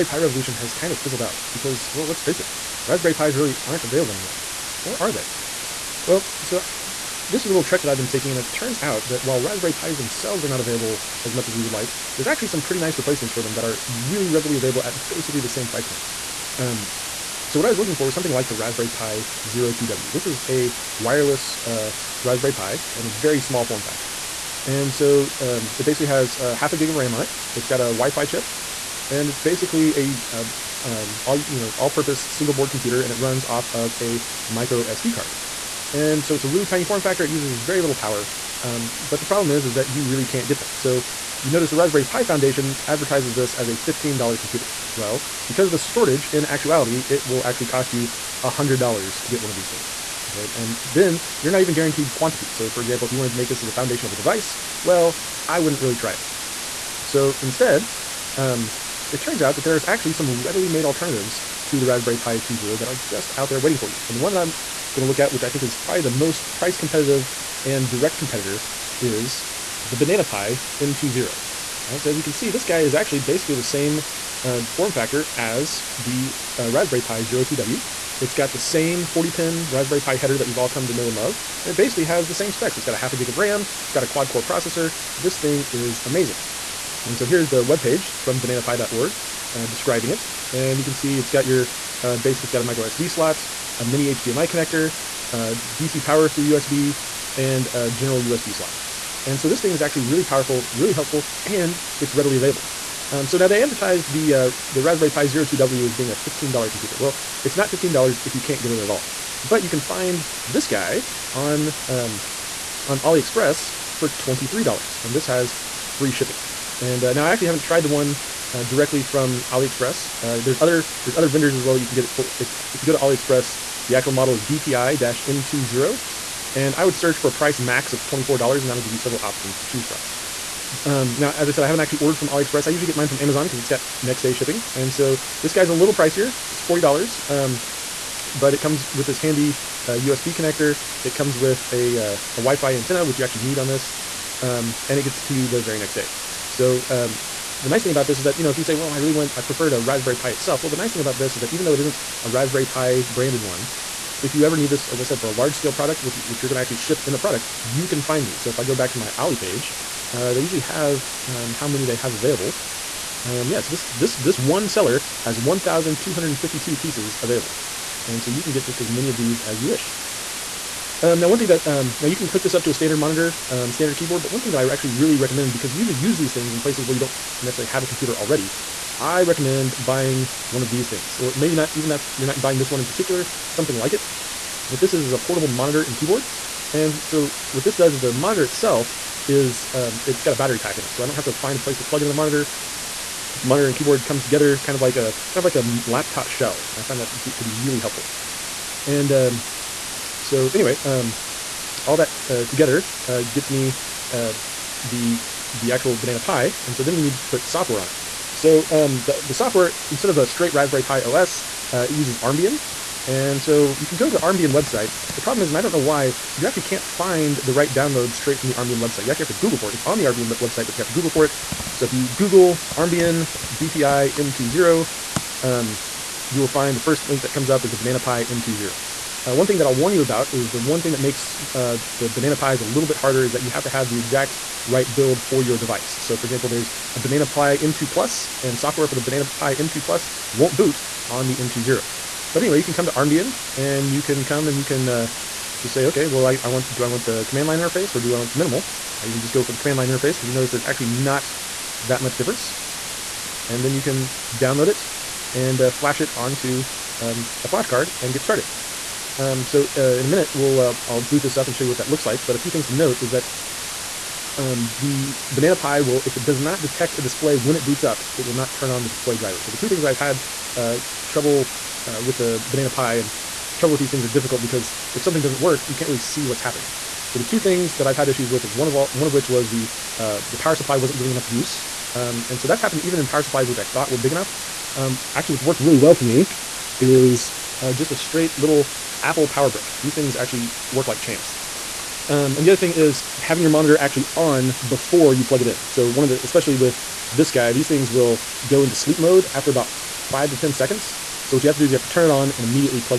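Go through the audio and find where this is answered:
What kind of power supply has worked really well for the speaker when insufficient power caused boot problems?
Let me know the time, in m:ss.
4:49.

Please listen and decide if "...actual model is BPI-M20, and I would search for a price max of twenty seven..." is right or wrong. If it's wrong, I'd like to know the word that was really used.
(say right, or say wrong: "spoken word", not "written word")
wrong: "four", not "seven".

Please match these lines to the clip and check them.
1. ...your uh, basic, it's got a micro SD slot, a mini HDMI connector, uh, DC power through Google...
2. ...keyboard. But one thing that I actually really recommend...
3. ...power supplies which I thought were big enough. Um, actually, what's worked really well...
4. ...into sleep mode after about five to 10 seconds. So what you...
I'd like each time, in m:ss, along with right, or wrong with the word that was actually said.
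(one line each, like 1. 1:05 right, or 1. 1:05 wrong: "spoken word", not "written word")
1. 1:31 wrong: "USB", not "Google"
2. 2:53 right
3. 4:43 right
4. 4:58 right.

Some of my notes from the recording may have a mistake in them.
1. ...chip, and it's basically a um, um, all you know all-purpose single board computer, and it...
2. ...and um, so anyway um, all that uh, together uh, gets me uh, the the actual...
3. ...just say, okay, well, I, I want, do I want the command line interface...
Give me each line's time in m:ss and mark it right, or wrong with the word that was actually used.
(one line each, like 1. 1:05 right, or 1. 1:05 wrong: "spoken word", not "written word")
1. 0:28 right
2. 3:18 right
3. 4:05 right.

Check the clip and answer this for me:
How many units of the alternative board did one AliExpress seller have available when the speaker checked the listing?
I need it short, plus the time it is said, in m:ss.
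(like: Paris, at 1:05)
1,252, at 2:45.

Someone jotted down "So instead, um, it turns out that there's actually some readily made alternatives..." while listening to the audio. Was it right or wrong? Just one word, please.
right.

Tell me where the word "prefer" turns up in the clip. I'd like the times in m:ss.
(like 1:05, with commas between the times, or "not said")
2:29.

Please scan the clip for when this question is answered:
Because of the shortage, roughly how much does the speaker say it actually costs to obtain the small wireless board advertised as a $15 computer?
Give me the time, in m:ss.
0:48.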